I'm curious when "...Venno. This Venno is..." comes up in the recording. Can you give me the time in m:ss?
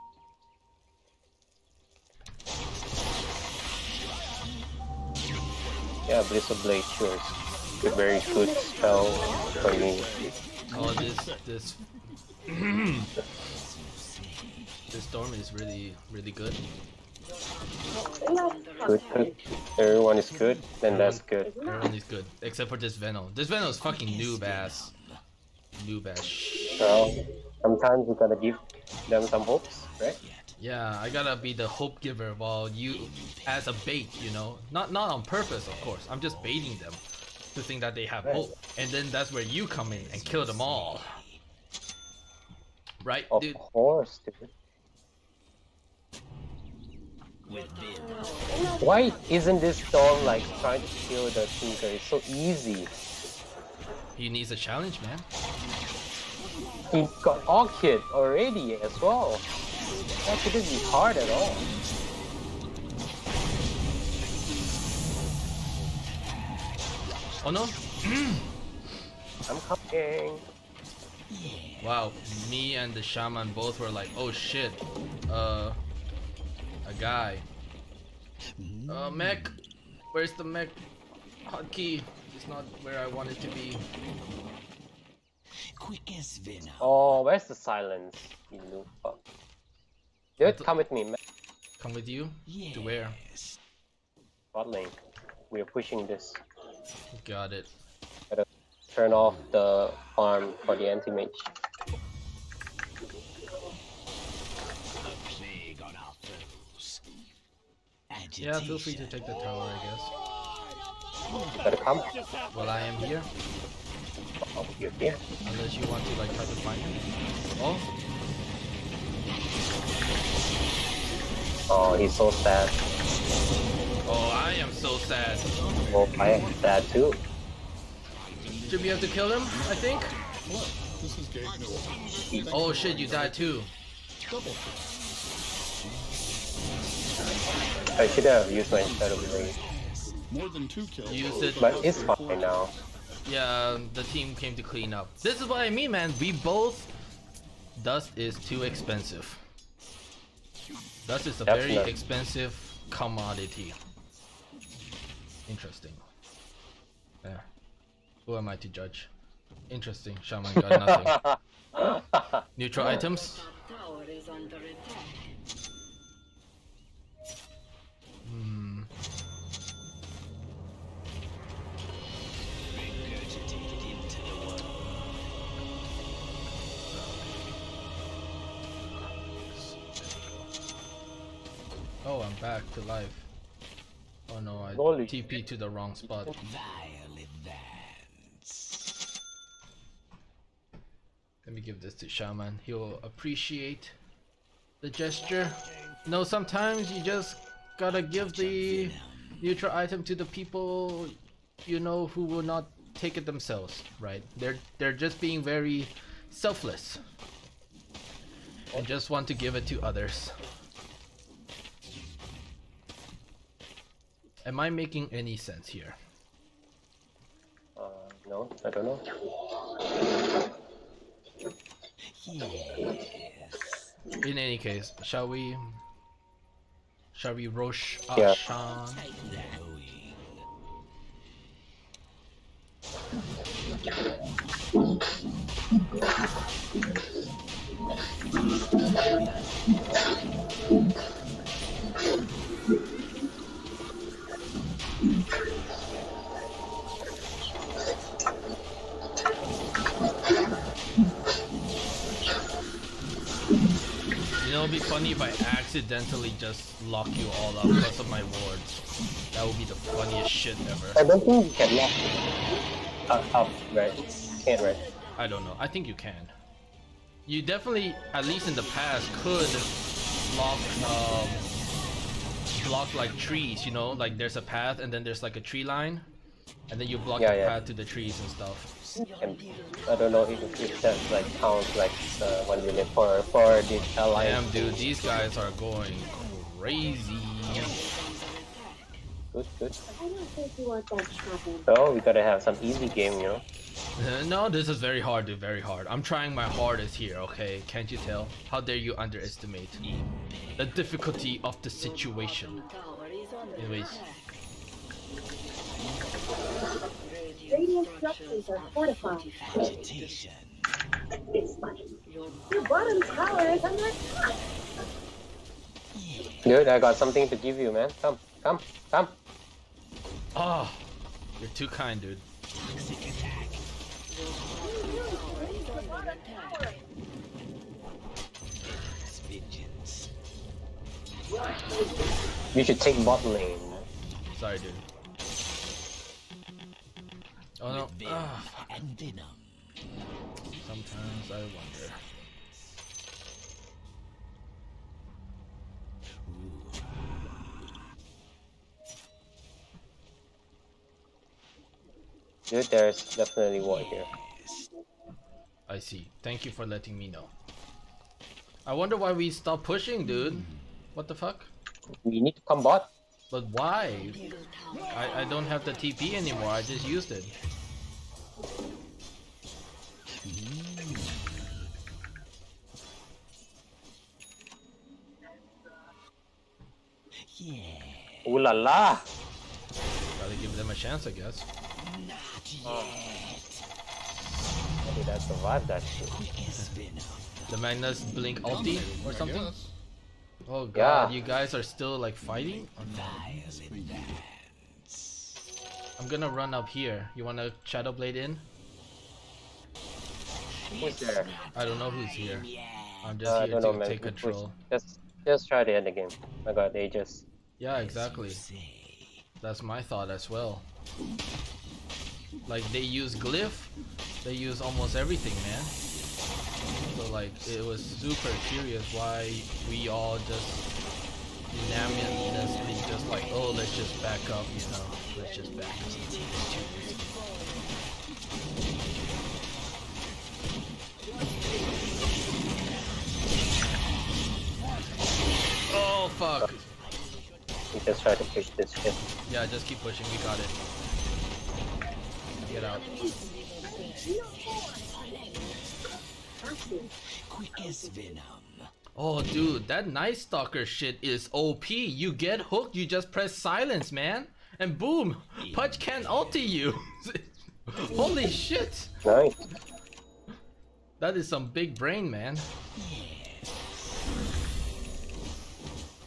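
0:22.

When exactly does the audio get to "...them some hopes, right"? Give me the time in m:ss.
0:29.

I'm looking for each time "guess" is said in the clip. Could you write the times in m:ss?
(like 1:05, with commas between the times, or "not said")
1:51, 6:21.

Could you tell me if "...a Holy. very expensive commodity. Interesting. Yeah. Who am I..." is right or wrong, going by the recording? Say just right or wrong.
wrong.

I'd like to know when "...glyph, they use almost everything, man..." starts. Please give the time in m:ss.
6:53.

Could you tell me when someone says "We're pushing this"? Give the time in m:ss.
1:35.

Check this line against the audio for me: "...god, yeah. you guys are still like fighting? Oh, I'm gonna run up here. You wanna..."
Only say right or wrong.
right.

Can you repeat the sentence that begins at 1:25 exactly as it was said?
Quick as Oh, where's the silence?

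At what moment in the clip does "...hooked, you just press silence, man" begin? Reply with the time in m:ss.
7:32.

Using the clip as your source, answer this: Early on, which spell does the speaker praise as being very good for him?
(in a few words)
Blizzard Blade.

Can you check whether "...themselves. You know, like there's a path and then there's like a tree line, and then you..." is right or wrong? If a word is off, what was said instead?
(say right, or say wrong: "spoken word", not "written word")
wrong: "trees", not "themselves".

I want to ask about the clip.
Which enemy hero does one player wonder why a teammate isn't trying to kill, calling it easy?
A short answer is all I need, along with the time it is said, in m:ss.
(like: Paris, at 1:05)
Tinker, at 0:51.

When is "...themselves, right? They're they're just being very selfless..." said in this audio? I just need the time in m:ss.
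3:23.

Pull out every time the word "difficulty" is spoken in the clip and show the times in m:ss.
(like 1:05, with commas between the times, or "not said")
5:00.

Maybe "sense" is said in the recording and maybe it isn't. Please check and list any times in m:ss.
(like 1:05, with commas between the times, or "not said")
3:35.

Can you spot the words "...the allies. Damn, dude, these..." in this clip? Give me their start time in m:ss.
4:43.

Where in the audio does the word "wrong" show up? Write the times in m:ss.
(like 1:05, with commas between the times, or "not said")
3:05.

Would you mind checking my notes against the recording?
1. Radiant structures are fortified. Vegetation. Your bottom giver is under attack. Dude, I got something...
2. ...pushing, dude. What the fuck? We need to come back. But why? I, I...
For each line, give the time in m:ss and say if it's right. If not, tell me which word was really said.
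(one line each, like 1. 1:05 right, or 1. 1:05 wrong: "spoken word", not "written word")
1. 5:07 wrong: "tower", not "giver"
2. 5:59 right.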